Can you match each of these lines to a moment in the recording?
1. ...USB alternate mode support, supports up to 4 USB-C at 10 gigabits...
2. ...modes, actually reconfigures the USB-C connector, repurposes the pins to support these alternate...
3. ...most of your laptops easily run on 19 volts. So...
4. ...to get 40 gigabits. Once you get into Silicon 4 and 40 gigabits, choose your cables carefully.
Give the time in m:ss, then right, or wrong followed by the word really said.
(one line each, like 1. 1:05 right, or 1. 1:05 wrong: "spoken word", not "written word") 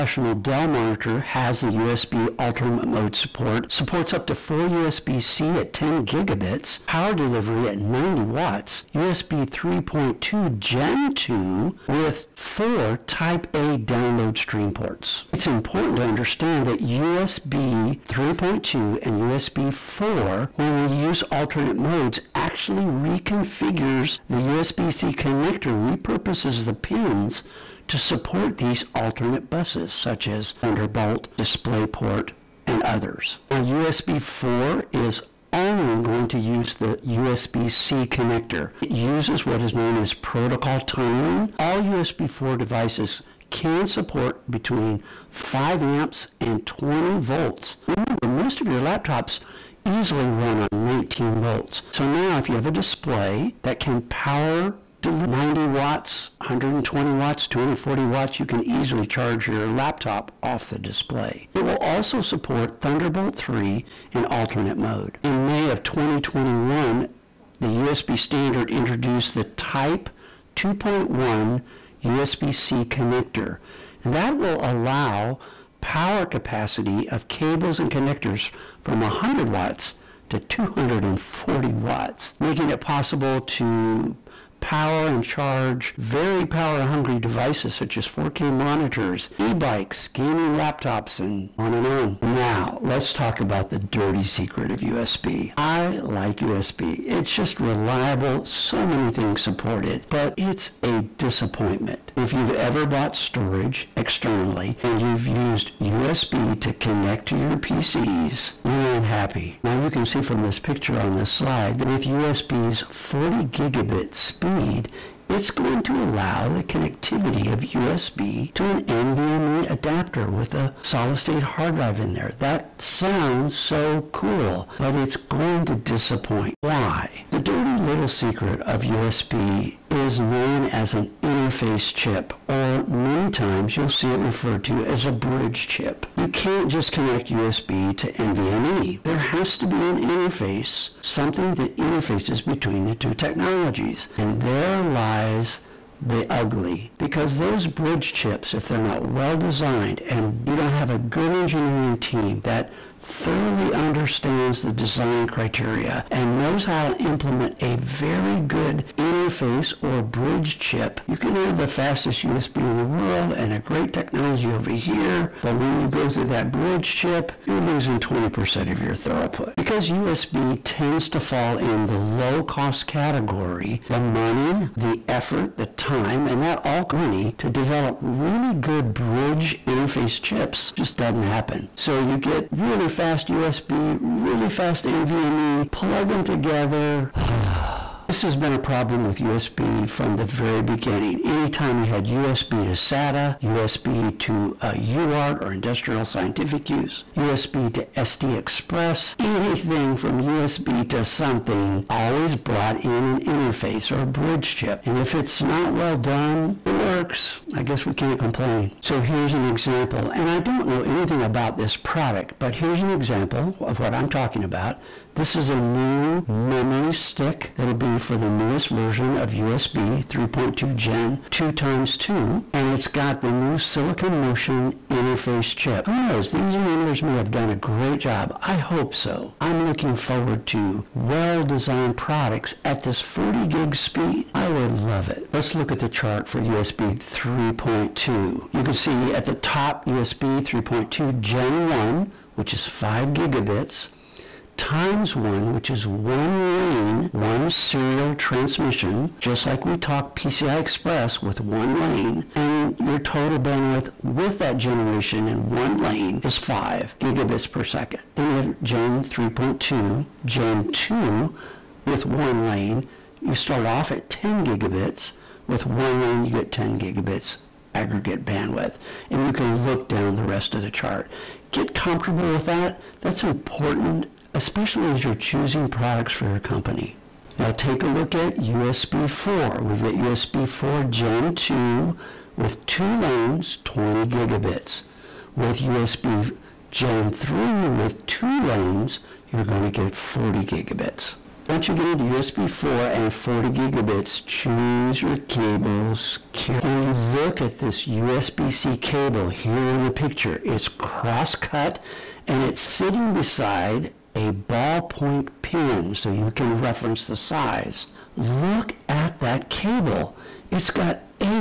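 1. 0:01 right
2. 0:21 right
3. 0:48 right
4. 4:49 wrong: "USB", not "Silicon".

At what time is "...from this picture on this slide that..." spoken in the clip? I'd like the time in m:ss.
1:50.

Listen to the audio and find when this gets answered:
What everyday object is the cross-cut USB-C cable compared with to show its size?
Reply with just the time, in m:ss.
5:04.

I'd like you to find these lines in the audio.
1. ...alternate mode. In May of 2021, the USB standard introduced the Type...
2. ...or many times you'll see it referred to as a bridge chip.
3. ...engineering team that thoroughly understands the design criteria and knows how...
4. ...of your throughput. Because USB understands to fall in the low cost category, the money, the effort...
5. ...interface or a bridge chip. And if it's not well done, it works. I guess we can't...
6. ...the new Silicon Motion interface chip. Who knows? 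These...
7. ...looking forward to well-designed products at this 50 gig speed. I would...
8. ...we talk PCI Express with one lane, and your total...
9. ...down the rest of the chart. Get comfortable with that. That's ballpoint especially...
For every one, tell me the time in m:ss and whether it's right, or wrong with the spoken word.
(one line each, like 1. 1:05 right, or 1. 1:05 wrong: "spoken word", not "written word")
1. 1:04 right
2. 2:12 right
3. 2:31 right
4. 2:48 wrong: "tends", not "understands"
5. 3:23 right
6. 3:43 right
7. 3:49 wrong: "40", not "50"
8. 4:09 right
9. 4:29 wrong: "important", not "ballpoint".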